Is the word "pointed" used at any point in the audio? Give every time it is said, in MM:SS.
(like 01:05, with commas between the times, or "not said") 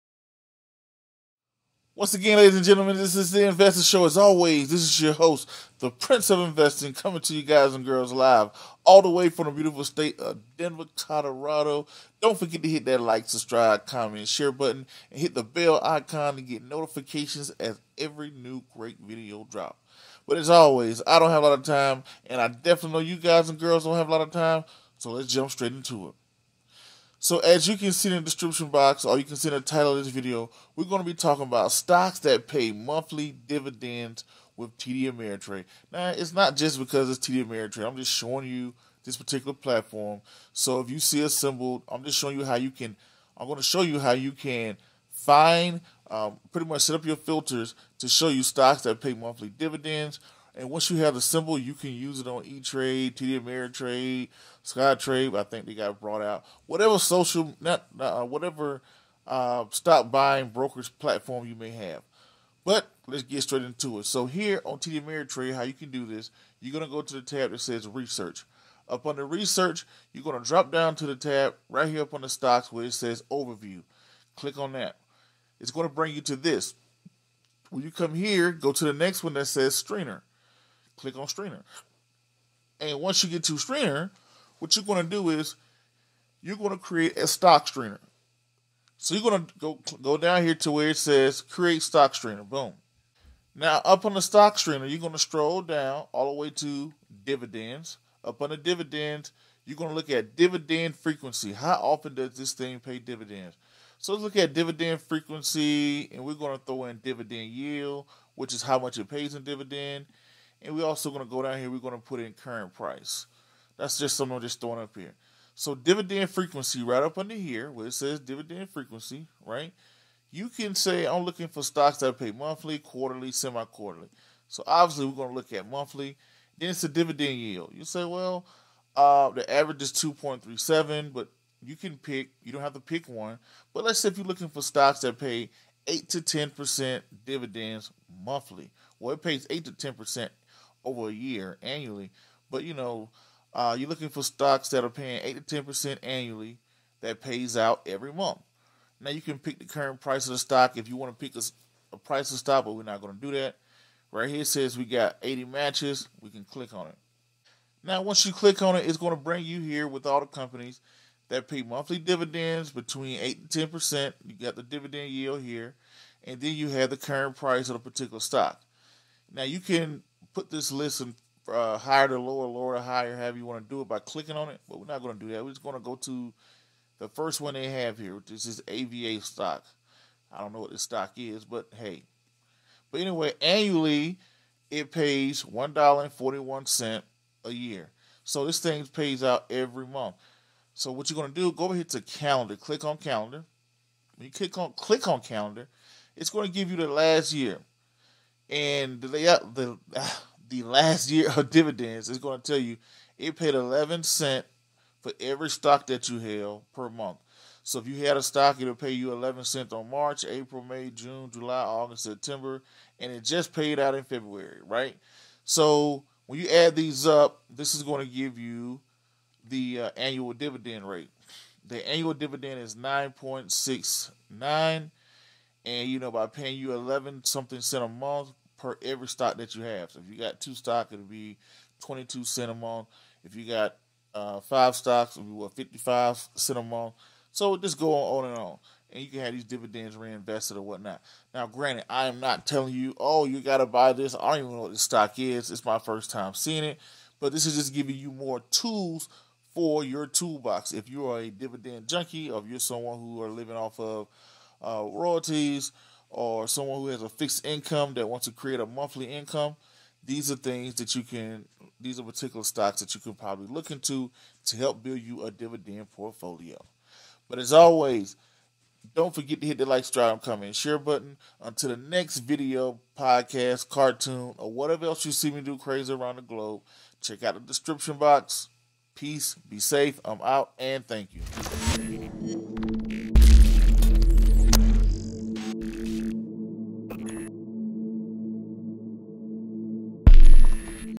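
not said.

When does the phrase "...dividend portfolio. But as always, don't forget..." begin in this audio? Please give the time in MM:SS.
04:25.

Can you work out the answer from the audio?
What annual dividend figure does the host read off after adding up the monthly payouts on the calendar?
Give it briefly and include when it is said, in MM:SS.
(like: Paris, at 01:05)
9.69, at 03:42.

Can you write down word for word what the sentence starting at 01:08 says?
Up under Research, you're going to drop down to the tab right here up on the stocks where it says Overview.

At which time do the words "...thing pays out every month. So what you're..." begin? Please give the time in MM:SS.
03:08.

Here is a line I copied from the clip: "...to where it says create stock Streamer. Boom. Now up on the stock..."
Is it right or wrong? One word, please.
right.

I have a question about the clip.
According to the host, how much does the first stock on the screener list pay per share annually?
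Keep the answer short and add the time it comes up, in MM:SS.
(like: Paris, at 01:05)
$1.41, at 03:05.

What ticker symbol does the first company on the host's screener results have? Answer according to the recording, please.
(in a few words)
AVA.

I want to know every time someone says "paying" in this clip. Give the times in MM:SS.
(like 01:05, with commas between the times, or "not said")
02:24, 03:46.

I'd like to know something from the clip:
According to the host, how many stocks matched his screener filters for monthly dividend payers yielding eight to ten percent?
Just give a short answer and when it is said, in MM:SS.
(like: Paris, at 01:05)
80, at 02:35.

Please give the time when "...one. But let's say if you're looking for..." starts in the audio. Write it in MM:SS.
02:13.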